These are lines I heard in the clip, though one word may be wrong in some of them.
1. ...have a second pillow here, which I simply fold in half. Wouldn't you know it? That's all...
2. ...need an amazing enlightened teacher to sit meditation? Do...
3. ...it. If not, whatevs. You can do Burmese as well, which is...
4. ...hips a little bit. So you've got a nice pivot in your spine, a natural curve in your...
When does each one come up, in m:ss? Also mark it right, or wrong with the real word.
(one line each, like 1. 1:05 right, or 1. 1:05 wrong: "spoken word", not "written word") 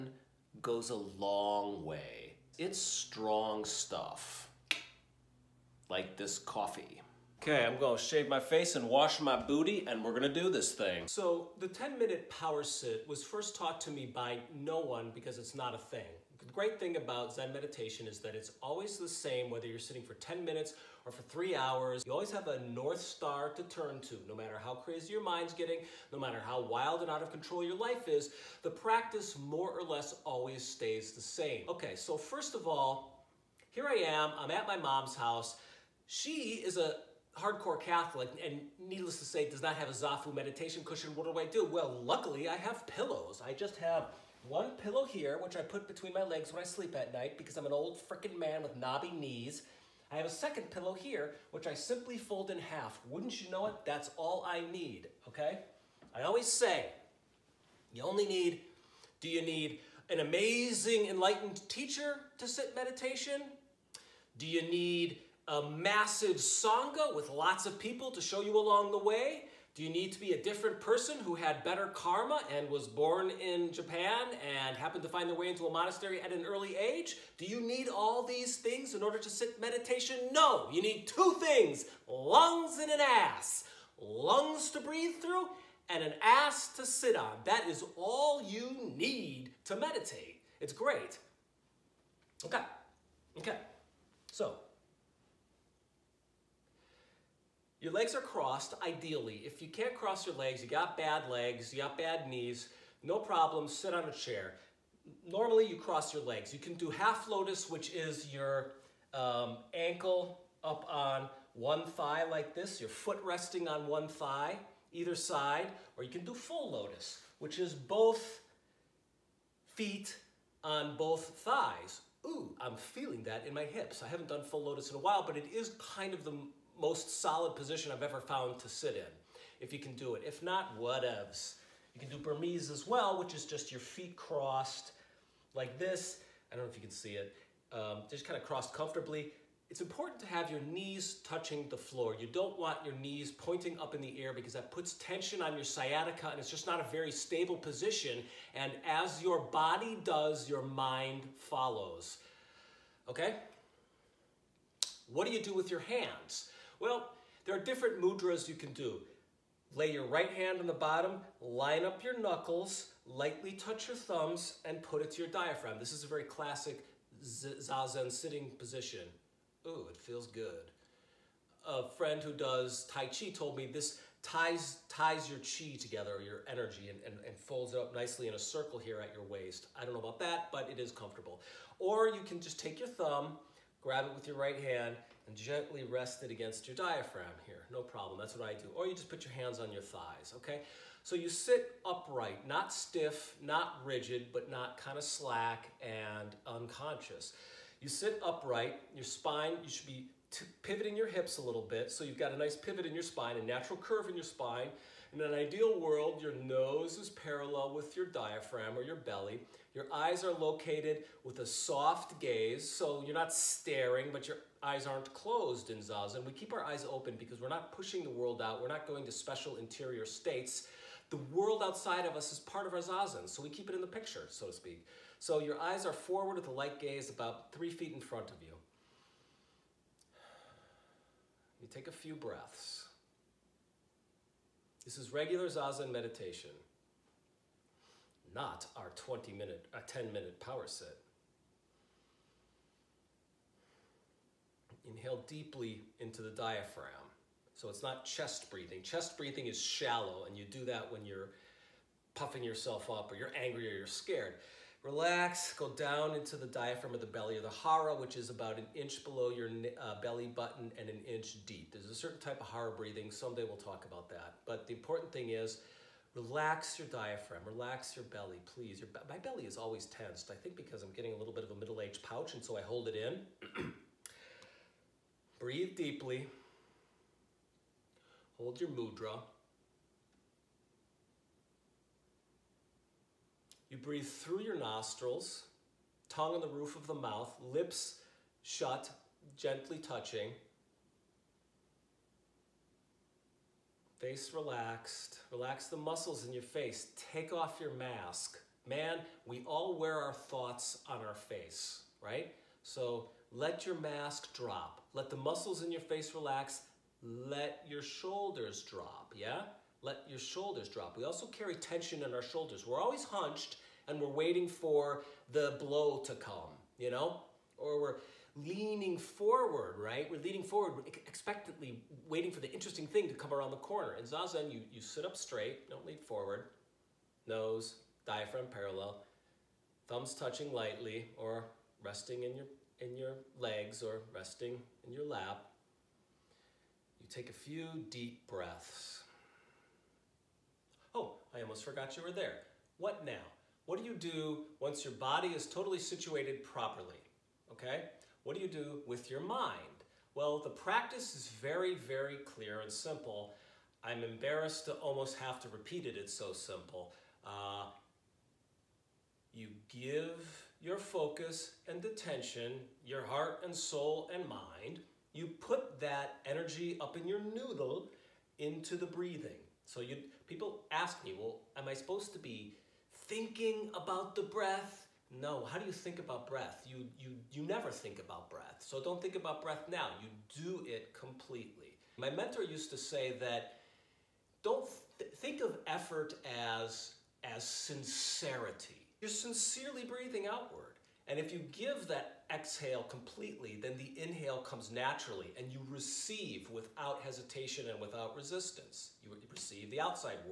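1. 0:50 right
2. 0:59 right
3. 2:10 right
4. 3:21 right.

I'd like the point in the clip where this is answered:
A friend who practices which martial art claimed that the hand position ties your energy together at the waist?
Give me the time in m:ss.
2:52.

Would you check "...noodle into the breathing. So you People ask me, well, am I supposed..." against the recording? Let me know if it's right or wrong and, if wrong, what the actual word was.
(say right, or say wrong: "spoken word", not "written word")
right.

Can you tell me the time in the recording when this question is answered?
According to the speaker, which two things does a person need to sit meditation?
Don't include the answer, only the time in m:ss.
1:22.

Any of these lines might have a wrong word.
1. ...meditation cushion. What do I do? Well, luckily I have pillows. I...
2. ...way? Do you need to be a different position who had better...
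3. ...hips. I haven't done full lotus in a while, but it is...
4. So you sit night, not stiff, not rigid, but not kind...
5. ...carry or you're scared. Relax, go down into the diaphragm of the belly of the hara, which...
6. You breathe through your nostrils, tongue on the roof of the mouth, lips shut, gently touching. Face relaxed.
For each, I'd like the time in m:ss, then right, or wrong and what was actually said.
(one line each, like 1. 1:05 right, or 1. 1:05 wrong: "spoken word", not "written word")
1. 0:40 right
2. 1:08 wrong: "person", not "position"
3. 2:03 right
4. 3:11 wrong: "upright", not "night"
5. 4:13 wrong: "angry", not "carry"
6. 4:43 right.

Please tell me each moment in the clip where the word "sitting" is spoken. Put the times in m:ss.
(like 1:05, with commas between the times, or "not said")
0:19, 2:48.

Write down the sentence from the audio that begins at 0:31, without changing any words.
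Okay, so first of all, here I am, I'm at my mom's house.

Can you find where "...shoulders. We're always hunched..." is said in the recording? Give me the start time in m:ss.
5:12.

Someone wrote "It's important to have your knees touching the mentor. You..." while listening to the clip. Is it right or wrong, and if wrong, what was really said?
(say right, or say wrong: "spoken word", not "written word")
wrong: "floor", not "mentor".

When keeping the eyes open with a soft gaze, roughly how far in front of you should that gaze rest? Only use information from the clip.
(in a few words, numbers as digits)
3 feet.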